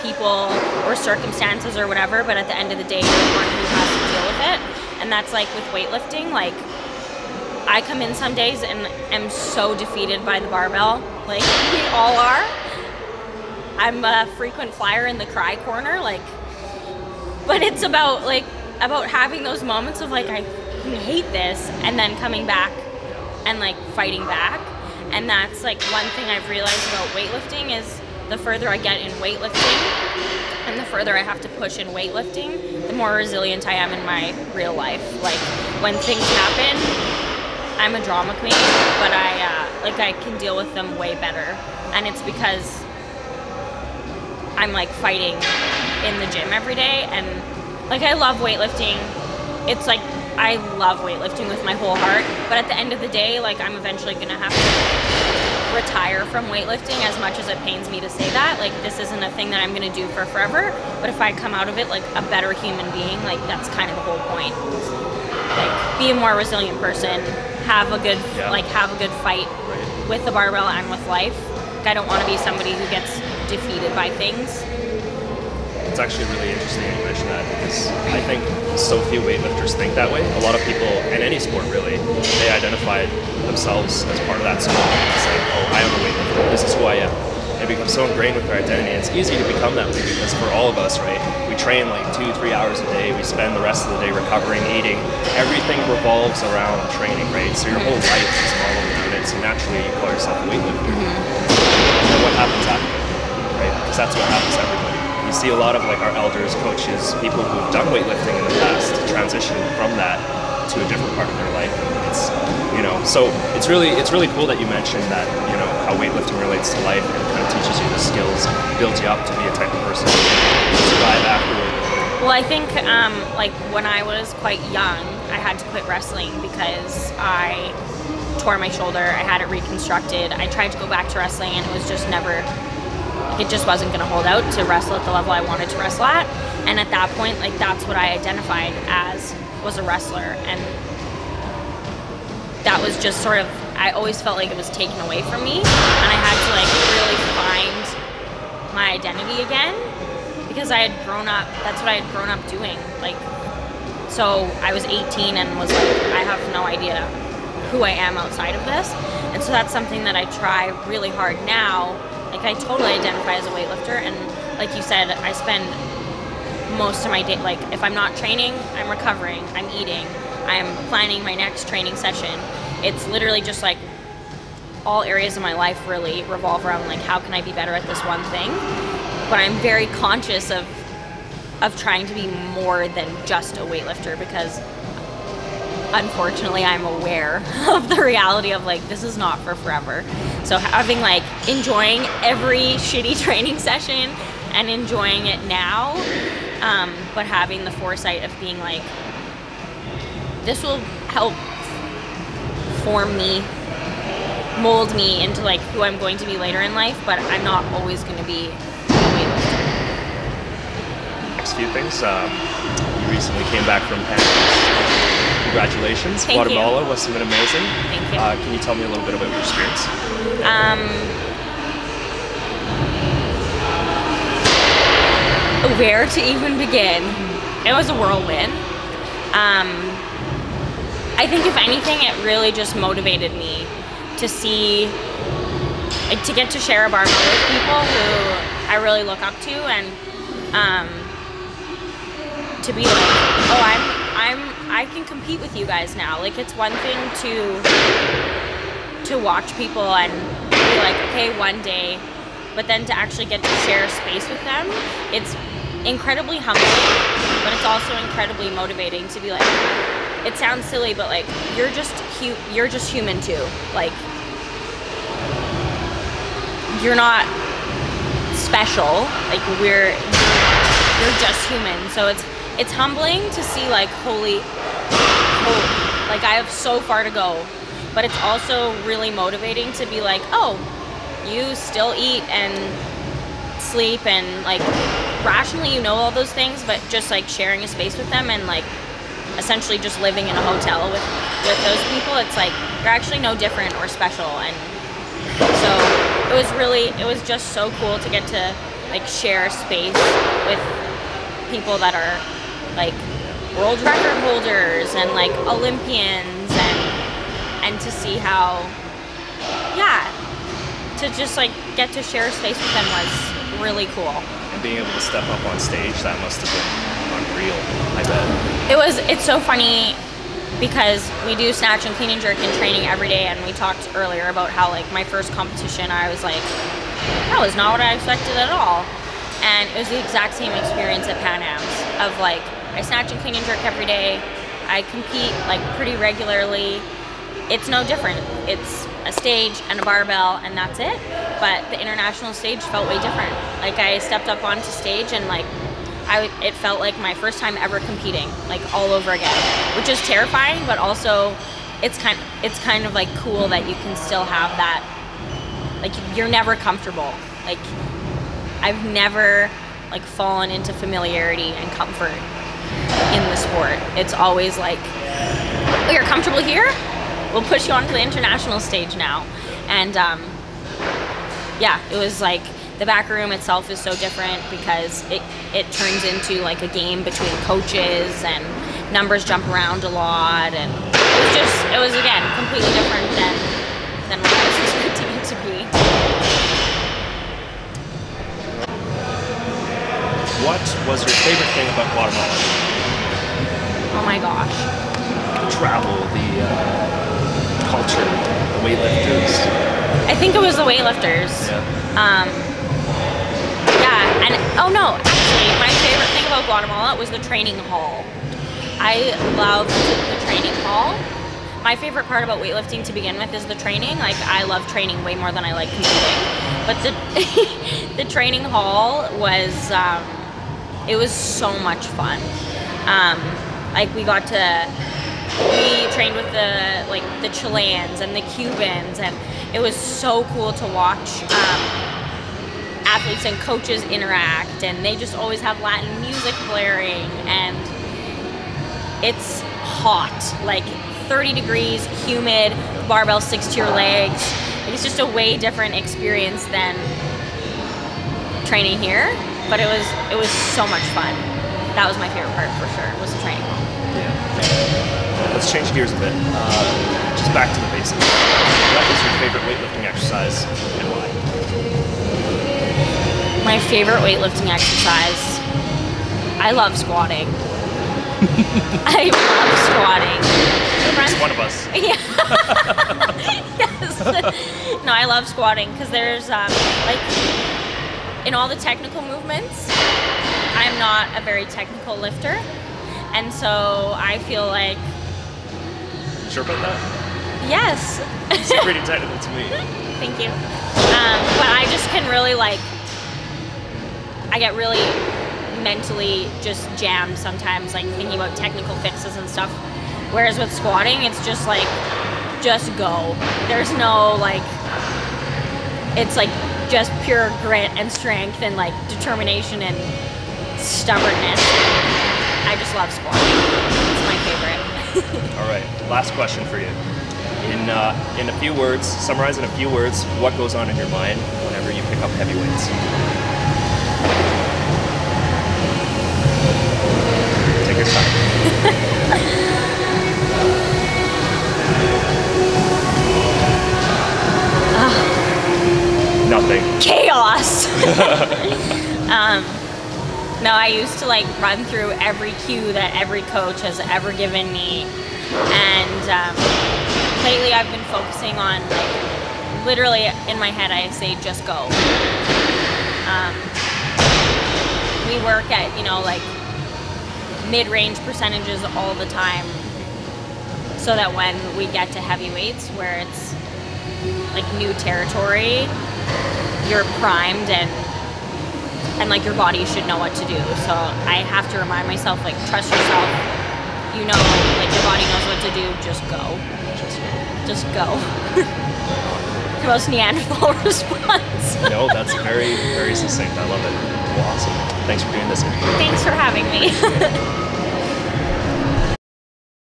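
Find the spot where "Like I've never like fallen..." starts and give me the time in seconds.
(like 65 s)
357 s.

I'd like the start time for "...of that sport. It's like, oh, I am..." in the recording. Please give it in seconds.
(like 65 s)
84 s.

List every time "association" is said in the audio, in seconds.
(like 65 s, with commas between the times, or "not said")
not said.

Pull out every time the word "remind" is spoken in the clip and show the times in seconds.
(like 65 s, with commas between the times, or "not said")
571 s.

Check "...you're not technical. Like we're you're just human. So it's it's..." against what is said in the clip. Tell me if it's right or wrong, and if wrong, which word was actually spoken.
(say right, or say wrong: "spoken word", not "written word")
wrong: "special", not "technical".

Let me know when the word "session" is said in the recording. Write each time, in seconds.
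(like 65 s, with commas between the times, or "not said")
171 s, 193 s.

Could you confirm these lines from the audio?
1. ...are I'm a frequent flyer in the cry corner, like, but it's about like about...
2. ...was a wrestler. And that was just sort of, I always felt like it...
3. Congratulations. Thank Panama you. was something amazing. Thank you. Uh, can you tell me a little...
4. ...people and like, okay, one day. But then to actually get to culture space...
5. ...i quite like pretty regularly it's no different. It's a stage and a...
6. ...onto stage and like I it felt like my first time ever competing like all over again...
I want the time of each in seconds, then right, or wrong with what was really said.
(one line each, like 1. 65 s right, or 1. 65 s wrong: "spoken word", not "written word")
1. 12 s right
2. 139 s right
3. 215 s wrong: "Guatemala", not "Panama"
4. 249 s wrong: "share", not "culture"
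5. 334 s wrong: "compete", not "quite"
6. 344 s right.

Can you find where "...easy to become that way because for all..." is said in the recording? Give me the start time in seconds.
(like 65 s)
89 s.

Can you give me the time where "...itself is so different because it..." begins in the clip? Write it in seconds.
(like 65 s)
373 s.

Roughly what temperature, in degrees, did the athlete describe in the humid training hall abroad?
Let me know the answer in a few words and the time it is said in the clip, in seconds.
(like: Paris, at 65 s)
30, at 441 s.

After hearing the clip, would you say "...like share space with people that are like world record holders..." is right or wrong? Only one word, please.
right.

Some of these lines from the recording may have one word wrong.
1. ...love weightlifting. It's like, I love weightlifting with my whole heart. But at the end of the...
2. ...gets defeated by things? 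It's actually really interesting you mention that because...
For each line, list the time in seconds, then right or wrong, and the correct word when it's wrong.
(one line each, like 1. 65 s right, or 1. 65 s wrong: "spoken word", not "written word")
1. 48 s right
2. 72 s right.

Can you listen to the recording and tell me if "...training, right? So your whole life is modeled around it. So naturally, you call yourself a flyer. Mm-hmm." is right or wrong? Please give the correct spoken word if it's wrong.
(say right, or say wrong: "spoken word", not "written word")
wrong: "weightlifter", not "flyer".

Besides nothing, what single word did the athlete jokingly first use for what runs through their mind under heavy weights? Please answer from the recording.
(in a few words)
Chaos.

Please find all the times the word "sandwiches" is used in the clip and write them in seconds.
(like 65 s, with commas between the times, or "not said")
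not said.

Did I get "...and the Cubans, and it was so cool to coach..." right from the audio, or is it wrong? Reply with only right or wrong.
wrong.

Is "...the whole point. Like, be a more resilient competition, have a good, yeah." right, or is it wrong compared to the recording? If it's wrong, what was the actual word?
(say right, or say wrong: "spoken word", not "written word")
wrong: "person", not "competition".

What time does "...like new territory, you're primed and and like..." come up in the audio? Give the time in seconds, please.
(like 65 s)
564 s.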